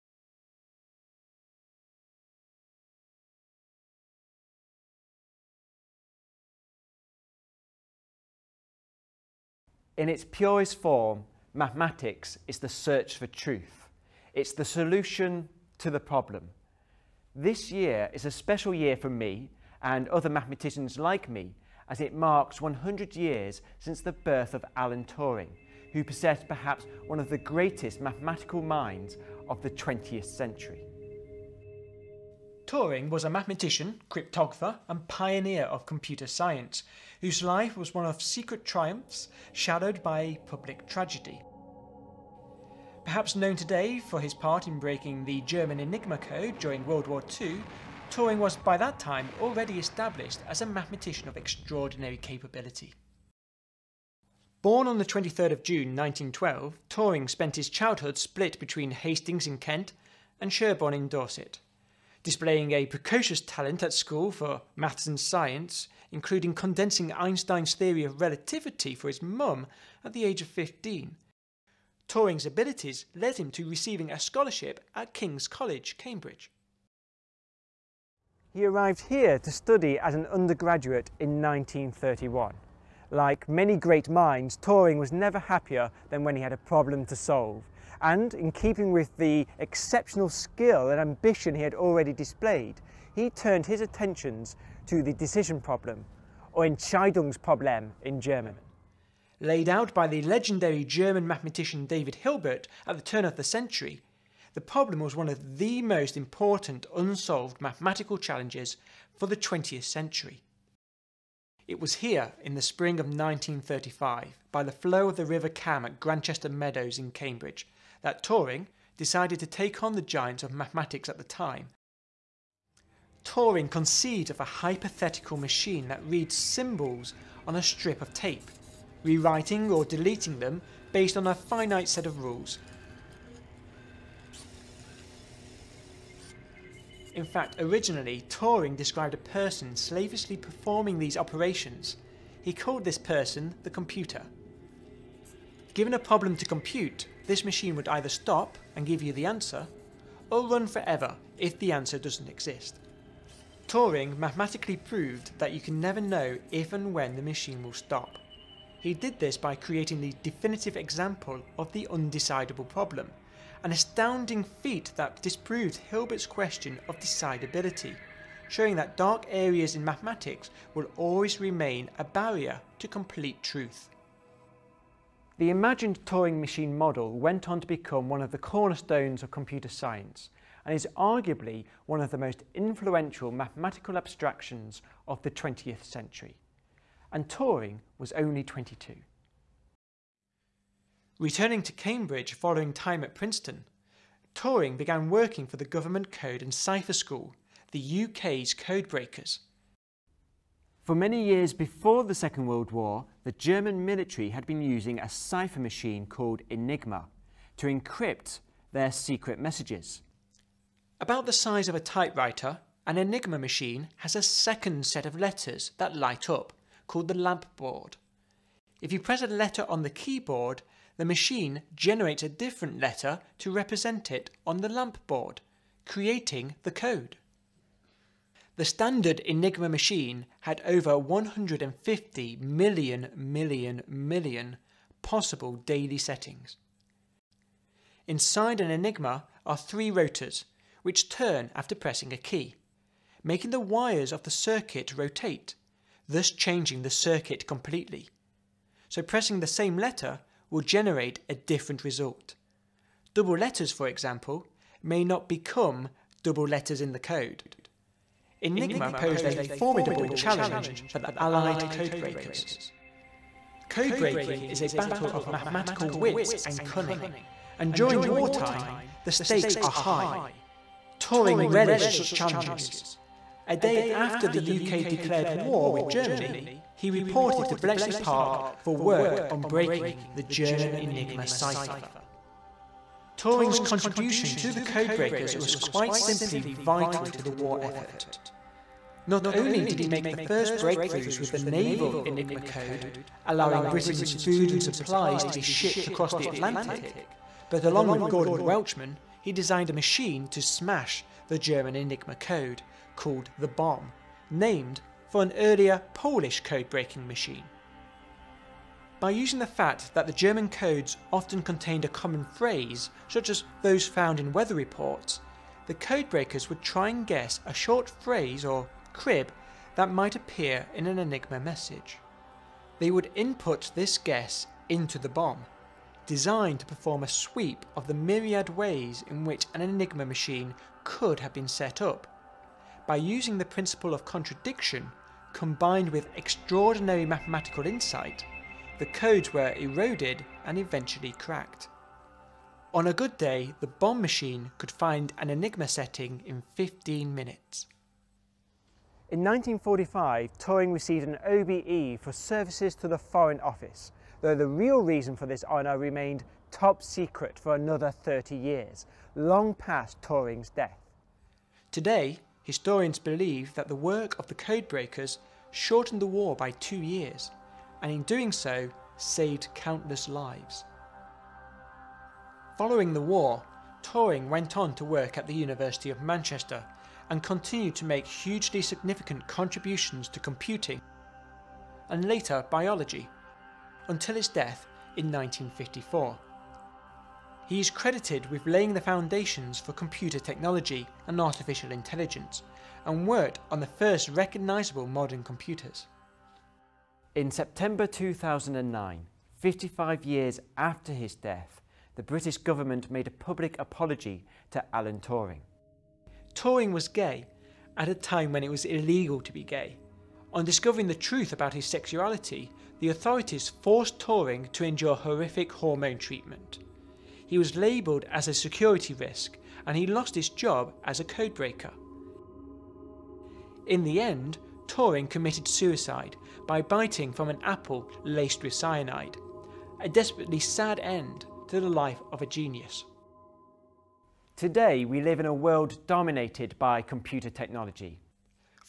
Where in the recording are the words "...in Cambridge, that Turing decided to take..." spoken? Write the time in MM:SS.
01:56.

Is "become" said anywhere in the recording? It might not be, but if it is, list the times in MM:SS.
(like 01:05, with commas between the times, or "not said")
02:57, 04:15.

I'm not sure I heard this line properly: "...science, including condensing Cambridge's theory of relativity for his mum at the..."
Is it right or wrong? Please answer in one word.
wrong.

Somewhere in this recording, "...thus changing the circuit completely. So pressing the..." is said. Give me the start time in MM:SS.
04:06.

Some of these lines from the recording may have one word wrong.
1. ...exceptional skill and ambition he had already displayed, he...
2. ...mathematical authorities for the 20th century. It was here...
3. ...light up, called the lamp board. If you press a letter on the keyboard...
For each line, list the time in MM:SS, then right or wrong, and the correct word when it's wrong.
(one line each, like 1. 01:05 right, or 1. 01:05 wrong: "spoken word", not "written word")
1. 01:29 right
2. 01:47 wrong: "challenges", not "authorities"
3. 03:35 right.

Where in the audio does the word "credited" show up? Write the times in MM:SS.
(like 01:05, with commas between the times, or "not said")
06:27.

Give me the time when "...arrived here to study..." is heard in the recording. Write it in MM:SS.
01:18.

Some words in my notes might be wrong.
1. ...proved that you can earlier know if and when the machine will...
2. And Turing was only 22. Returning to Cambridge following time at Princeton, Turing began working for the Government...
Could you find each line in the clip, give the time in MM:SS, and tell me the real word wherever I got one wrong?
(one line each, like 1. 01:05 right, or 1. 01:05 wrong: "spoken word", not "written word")
1. 02:34 wrong: "never", not "earlier"
2. 03:07 right.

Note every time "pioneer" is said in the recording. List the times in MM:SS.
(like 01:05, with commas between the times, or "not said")
00:35.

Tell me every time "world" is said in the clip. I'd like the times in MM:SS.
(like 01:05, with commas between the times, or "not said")
00:46, 03:22, 07:15.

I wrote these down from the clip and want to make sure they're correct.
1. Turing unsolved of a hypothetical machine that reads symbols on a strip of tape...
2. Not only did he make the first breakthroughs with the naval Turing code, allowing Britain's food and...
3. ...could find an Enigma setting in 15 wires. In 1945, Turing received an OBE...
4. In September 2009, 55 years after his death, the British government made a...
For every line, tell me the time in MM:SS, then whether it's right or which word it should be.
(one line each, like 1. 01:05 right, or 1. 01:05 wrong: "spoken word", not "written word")
1. 02:03 wrong: "conceived", not "unsolved"
2. 04:49 wrong: "Enigma", not "Turing"
3. 05:44 wrong: "minutes", not "wires"
4. 06:37 right.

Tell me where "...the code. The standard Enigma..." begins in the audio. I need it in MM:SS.
03:46.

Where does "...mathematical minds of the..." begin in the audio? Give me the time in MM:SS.
00:27.